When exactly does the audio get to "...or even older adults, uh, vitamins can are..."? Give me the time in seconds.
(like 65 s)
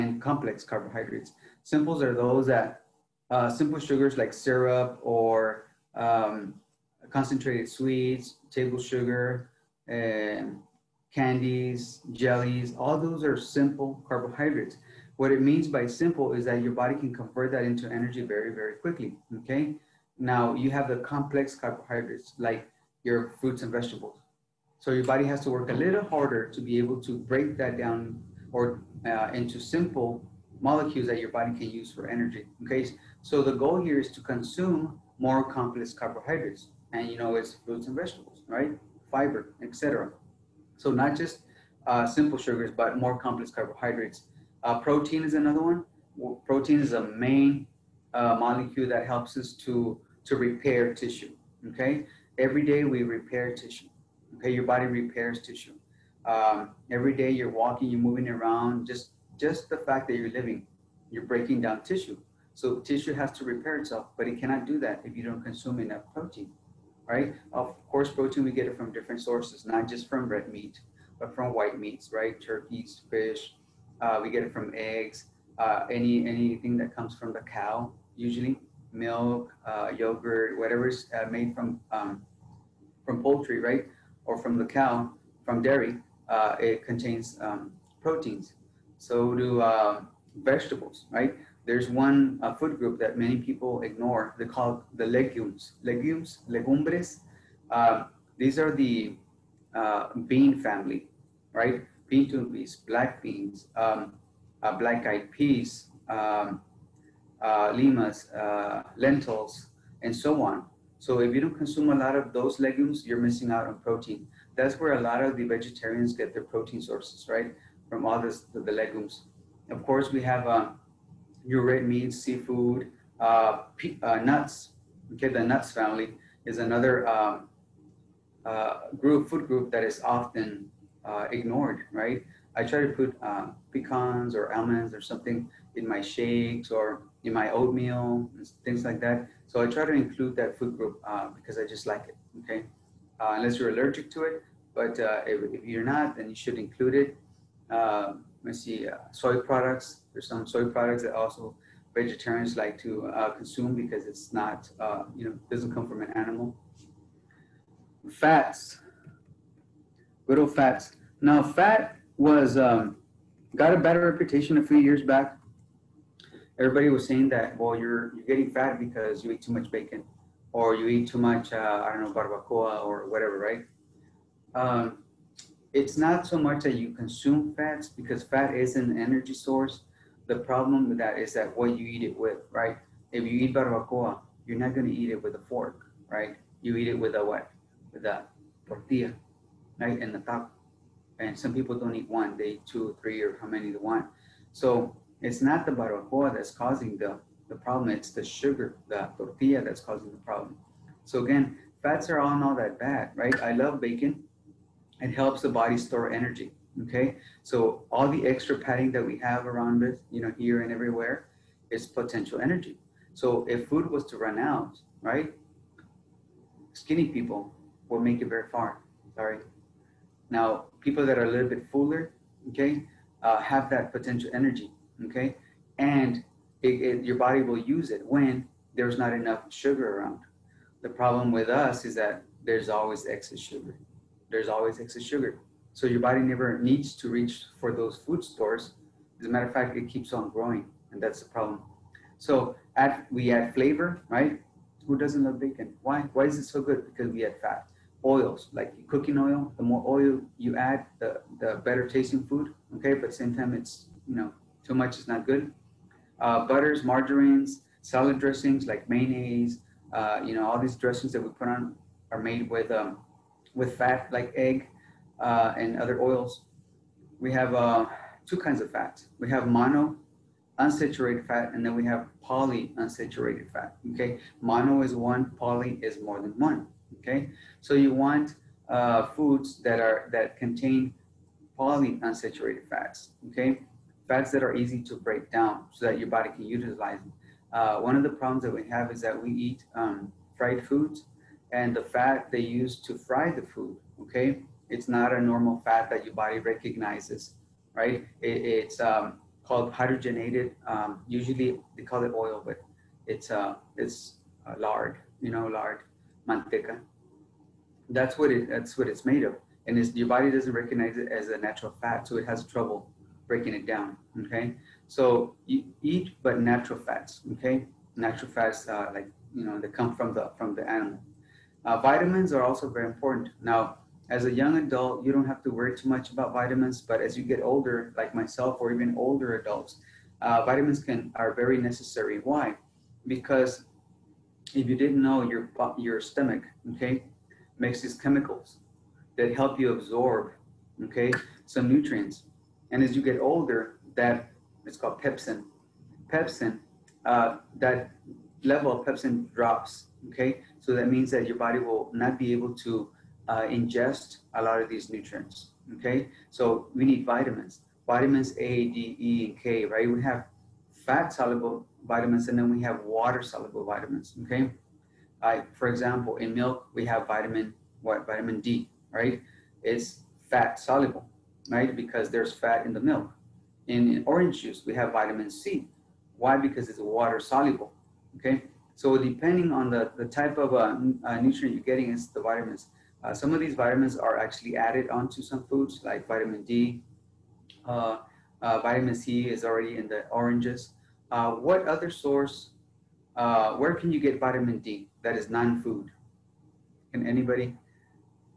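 328 s.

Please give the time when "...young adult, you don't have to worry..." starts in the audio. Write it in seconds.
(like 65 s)
324 s.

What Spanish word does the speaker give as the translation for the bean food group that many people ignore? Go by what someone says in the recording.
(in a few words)
legumbres.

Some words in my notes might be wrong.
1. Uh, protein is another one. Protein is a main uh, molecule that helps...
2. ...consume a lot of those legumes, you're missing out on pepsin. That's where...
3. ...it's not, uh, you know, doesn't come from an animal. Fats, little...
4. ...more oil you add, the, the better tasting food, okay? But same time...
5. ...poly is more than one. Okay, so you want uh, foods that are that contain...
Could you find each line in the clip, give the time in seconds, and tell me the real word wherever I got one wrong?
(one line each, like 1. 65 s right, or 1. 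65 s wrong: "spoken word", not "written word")
1. 44 s right
2. 111 s wrong: "protein", not "pepsin"
3. 154 s right
4. 249 s right
5. 275 s right.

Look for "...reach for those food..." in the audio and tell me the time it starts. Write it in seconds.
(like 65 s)
237 s.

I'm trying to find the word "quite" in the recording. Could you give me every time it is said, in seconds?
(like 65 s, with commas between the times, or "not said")
not said.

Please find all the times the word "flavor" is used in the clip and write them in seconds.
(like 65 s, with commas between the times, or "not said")
243 s.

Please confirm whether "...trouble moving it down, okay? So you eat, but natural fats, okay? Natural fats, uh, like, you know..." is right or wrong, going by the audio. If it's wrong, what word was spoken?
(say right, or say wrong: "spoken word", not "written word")
wrong: "breaking", not "moving".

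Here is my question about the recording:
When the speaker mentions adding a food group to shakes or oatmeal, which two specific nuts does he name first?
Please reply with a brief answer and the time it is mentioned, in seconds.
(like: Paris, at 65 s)
pecans or almonds, at 133 s.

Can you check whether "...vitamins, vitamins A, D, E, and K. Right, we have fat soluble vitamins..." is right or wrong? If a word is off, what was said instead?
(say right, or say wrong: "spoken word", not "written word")
right.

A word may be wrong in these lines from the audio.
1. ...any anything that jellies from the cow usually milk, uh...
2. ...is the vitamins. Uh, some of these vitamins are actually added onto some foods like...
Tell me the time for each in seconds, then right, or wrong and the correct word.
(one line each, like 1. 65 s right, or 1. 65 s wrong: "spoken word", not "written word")
1. 75 s wrong: "comes", not "jellies"
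2. 381 s right.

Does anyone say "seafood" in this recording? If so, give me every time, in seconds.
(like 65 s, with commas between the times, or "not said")
122 s.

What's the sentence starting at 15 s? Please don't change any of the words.
What it means by simple is that your body can convert that into energy very, very quickly, okay?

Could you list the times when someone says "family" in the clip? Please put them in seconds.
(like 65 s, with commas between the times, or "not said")
100 s, 125 s.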